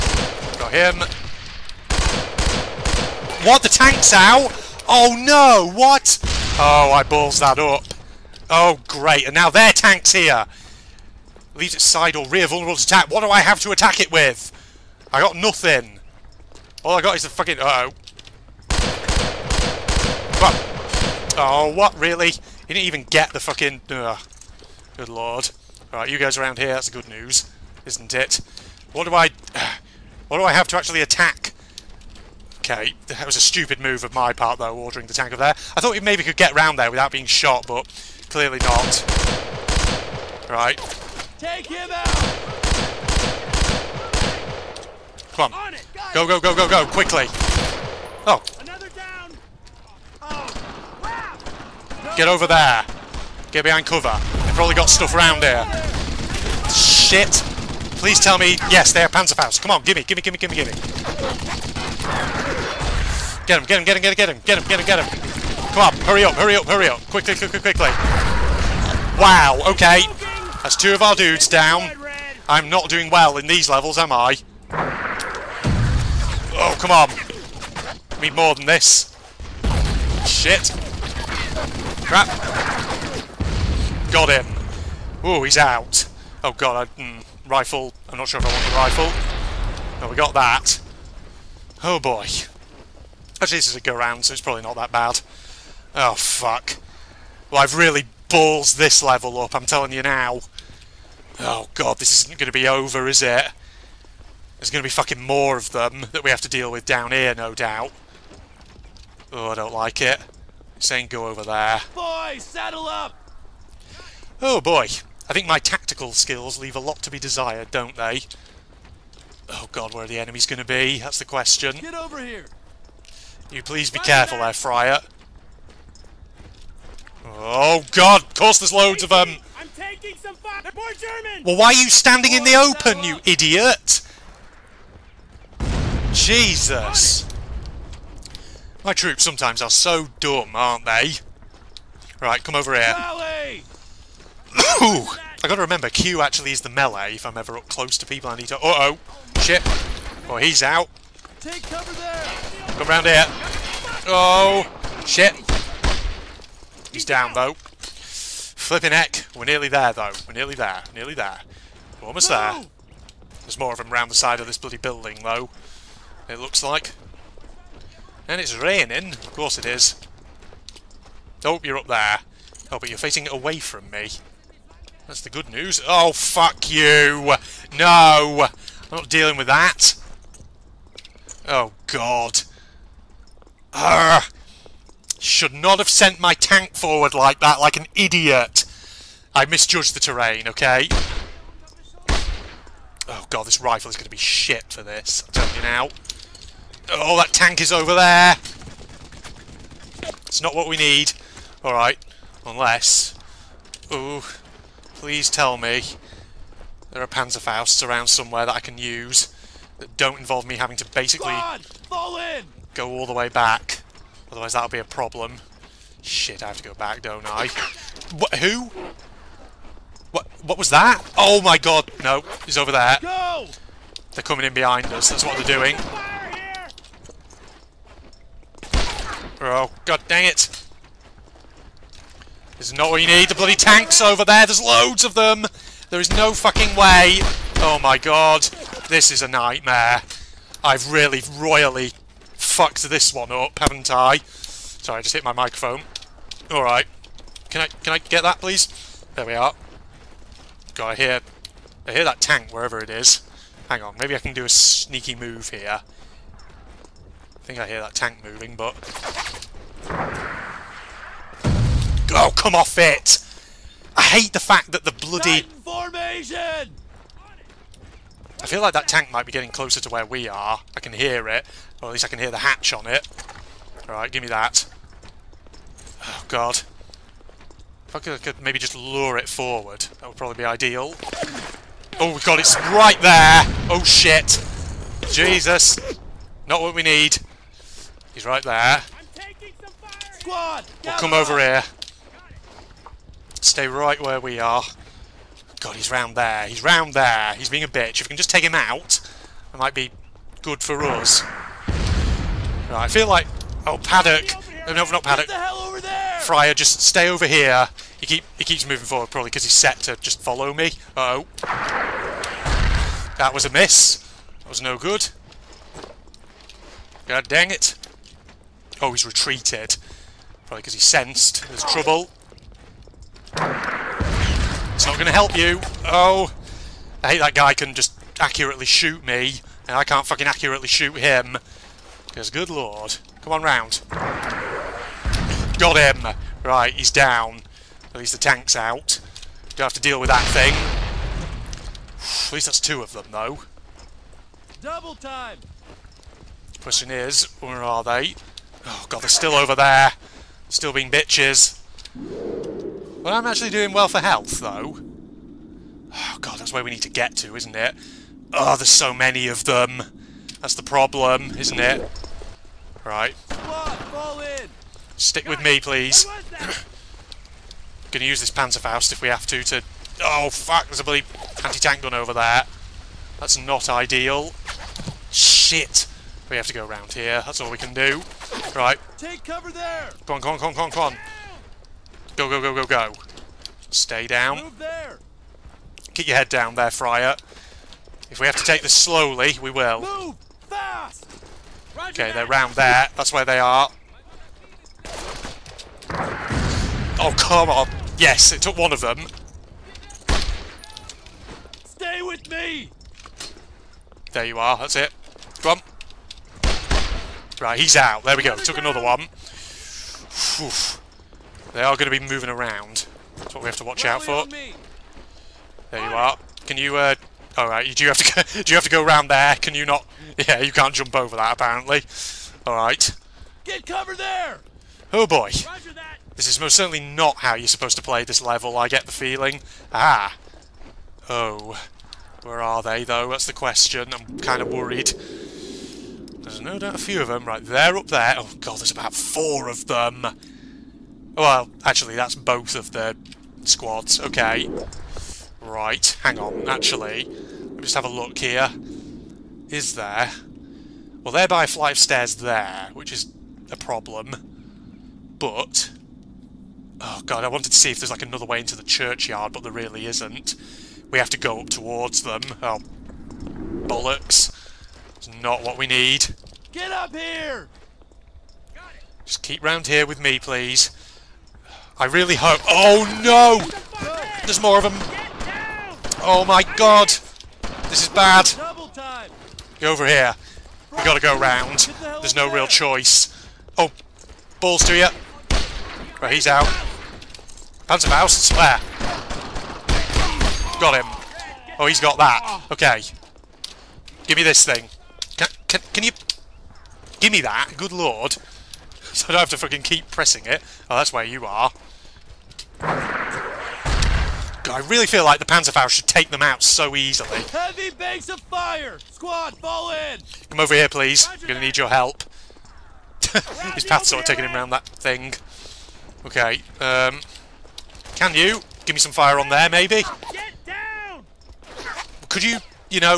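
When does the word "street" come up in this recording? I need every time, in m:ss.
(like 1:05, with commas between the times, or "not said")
not said.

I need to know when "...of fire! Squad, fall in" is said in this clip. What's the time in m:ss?
8:28.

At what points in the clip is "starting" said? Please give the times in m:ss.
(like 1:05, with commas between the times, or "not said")
not said.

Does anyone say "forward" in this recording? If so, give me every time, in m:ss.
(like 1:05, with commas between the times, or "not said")
3:06, 4:39, 5:08.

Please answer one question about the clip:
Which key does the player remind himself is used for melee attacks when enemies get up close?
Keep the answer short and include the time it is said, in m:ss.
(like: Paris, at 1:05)
Q, at 2:25.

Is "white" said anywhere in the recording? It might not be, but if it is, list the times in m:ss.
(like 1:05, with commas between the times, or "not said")
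not said.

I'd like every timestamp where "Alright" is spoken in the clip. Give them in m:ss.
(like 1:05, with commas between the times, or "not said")
3:21, 4:06, 4:33.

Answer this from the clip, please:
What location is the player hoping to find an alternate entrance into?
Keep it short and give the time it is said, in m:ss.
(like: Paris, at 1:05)
Churchyard, at 7:38.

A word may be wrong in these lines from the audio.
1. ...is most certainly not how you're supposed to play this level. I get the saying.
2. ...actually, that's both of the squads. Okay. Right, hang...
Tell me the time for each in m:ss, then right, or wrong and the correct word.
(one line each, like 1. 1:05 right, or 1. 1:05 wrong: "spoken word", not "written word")
1. 7:06 wrong: "feeling", not "saying"
2. 7:21 right.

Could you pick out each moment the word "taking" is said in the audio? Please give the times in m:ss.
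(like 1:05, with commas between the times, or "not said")
2:09, 8:34.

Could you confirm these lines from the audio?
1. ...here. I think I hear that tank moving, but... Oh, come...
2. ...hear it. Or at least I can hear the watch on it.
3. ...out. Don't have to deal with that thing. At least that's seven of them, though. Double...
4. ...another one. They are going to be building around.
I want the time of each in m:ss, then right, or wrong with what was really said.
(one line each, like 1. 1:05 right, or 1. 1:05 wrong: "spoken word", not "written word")
1. 4:15 right
2. 4:30 wrong: "hatch", not "watch"
3. 5:38 wrong: "two", not "seven"
4. 6:48 wrong: "moving", not "building".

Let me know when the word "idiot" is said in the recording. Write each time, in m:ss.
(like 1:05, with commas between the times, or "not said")
2:13, 3:07.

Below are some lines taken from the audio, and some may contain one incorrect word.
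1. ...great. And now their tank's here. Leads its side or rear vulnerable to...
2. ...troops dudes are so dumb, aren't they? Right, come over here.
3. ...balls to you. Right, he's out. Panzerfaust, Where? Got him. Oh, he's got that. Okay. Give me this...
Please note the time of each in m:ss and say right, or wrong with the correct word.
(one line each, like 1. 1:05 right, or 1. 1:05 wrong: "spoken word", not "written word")
1. 0:08 right
2. 2:18 wrong: "sometimes", not "dudes"
3. 8:04 right.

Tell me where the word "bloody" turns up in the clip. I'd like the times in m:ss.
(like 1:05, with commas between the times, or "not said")
2:44, 3:53, 4:24, 6:10.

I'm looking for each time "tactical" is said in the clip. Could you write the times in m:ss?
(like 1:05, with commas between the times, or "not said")
1:55.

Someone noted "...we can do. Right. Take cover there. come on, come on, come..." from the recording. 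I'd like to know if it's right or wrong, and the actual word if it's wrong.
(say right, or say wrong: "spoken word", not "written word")
right.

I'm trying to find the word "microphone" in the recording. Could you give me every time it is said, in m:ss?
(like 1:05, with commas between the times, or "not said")
4:05.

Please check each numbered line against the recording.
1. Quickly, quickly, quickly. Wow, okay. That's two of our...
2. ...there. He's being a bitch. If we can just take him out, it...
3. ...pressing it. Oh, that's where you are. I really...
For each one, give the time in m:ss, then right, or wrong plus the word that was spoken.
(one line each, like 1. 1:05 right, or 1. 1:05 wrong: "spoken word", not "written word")
1. 1:07 right
2. 4:56 right
3. 8:19 right.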